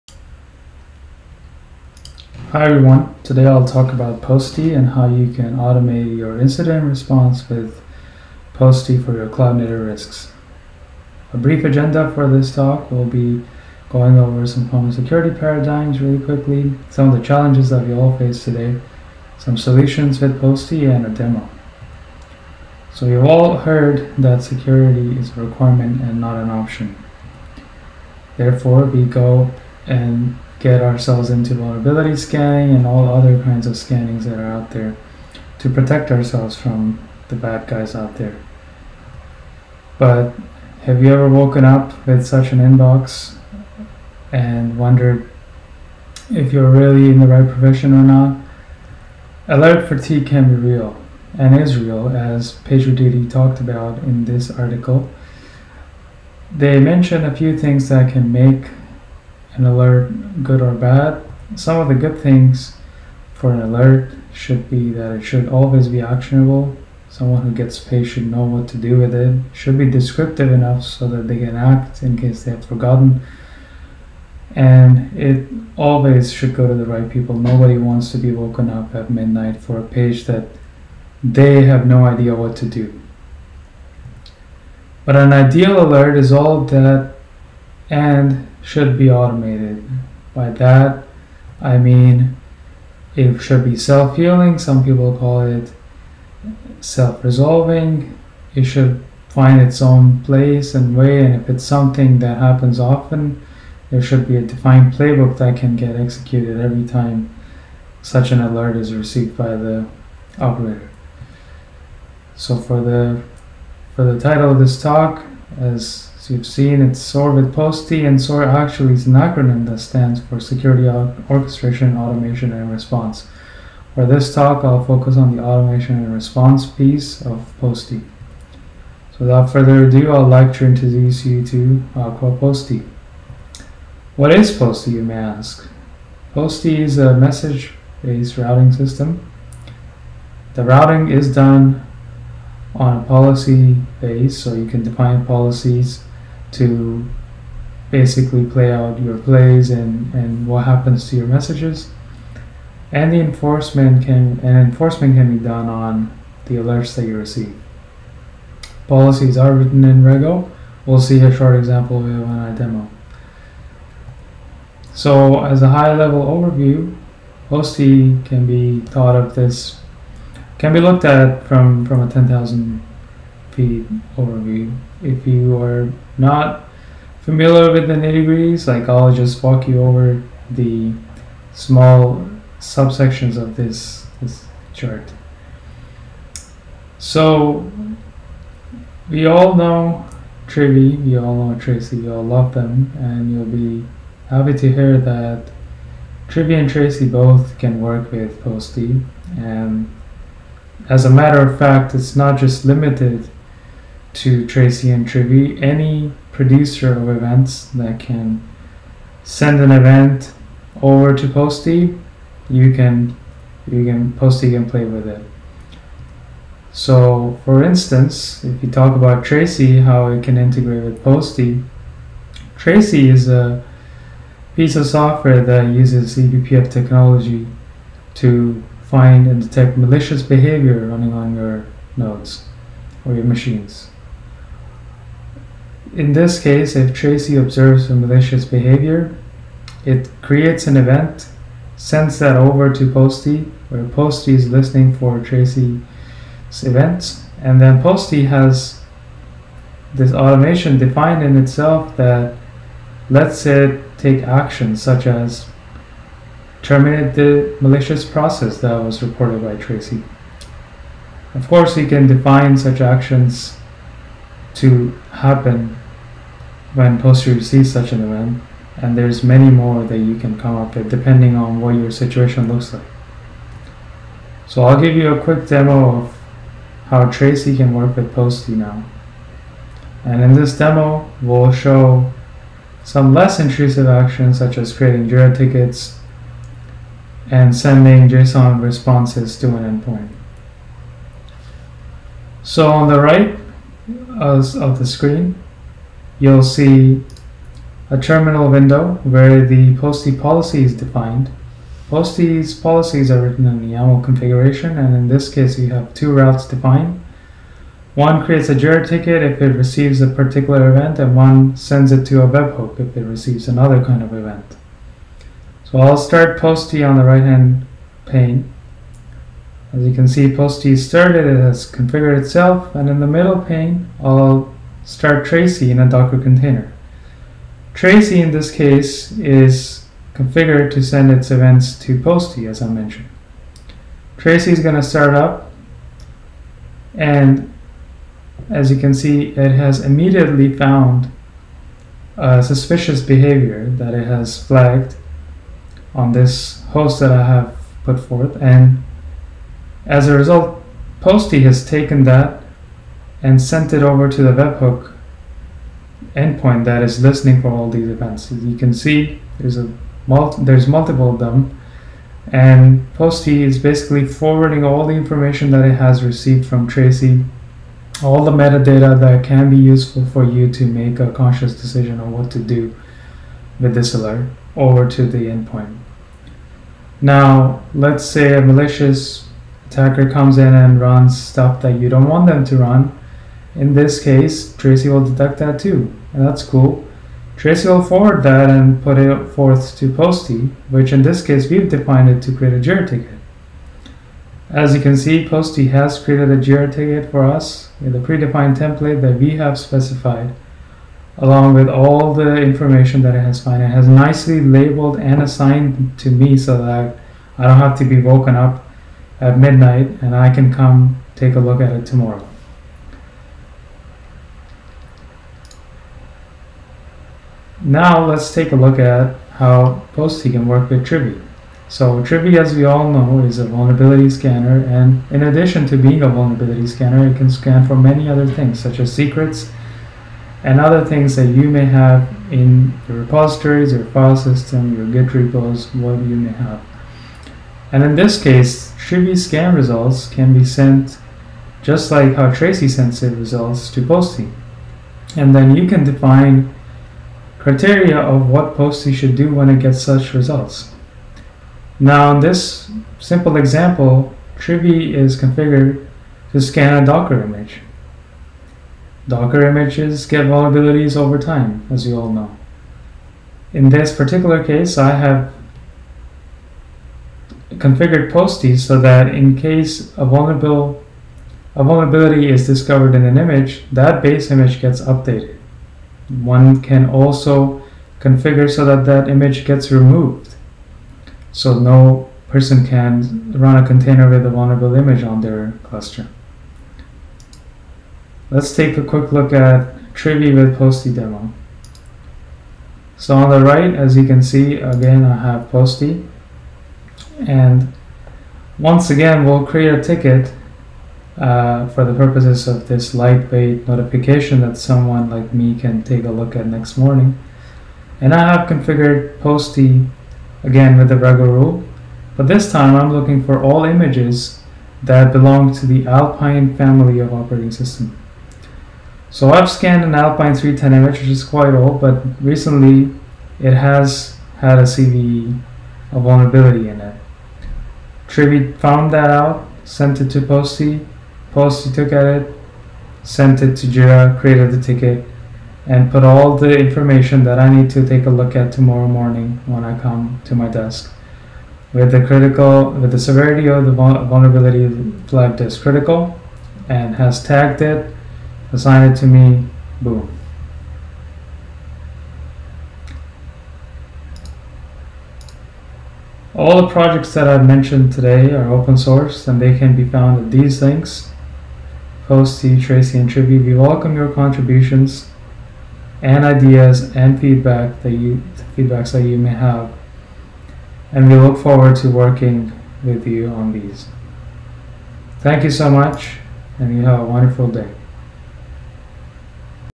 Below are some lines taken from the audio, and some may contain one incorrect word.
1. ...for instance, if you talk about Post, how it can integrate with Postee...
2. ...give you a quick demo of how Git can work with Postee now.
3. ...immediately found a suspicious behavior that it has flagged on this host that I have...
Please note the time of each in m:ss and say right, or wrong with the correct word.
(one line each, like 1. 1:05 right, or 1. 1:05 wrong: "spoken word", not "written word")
1. 3:37 wrong: "Tracee", not "Post"
2. 4:34 wrong: "Tracee", not "Git"
3. 5:39 right.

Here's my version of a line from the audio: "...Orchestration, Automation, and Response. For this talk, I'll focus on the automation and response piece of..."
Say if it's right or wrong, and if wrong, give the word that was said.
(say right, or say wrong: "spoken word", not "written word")
right.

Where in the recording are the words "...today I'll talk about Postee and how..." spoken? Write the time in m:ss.
0:03.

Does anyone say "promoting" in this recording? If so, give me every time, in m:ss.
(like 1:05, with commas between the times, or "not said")
not said.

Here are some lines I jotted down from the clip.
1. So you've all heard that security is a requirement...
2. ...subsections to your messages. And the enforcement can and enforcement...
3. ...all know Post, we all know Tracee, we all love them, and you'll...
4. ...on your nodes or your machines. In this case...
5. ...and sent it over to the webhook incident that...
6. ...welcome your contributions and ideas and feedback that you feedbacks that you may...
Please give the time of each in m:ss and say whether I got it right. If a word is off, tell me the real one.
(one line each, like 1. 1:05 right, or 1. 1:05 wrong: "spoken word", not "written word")
1. 0:22 right
2. 2:30 wrong: "happens", not "subsections"
3. 3:09 wrong: "Trivy", not "Post"
4. 3:51 right
5. 5:53 wrong: "endpoint", not "incident"
6. 9:23 right.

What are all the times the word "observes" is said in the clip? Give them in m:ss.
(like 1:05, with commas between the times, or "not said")
3:57.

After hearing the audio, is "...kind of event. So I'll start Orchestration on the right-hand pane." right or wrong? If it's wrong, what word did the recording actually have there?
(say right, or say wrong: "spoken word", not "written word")
wrong: "Postee", not "Orchestration".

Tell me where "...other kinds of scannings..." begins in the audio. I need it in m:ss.
0:33.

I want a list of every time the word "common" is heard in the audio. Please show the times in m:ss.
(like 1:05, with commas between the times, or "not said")
0:14.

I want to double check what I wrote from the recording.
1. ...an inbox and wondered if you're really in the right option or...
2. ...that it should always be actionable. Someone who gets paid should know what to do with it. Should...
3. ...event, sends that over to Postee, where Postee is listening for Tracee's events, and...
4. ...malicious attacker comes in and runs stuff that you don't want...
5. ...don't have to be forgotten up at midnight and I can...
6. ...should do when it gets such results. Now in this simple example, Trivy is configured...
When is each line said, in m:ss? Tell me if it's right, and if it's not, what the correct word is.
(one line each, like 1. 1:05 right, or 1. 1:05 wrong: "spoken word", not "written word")
1. 0:42 wrong: "profession", not "option"
2. 1:04 right
3. 4:00 right
4. 6:18 right
5. 6:47 wrong: "woken", not "forgotten"
6. 7:28 right.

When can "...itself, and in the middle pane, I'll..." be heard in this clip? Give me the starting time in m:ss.
5:22.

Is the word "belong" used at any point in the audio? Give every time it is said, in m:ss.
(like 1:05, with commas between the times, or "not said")
8:35.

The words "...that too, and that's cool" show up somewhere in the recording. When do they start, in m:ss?
6:25.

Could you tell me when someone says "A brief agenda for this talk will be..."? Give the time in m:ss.
0:11.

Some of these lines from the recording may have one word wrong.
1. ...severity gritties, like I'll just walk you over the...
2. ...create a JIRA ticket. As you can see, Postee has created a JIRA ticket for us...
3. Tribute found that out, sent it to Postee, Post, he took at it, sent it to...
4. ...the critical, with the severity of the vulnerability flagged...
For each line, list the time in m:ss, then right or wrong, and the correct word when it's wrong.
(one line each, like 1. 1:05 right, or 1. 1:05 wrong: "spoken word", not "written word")
1. 2:57 wrong: "nitty", not "severity"
2. 6:32 right
3. 8:48 right
4. 9:01 right.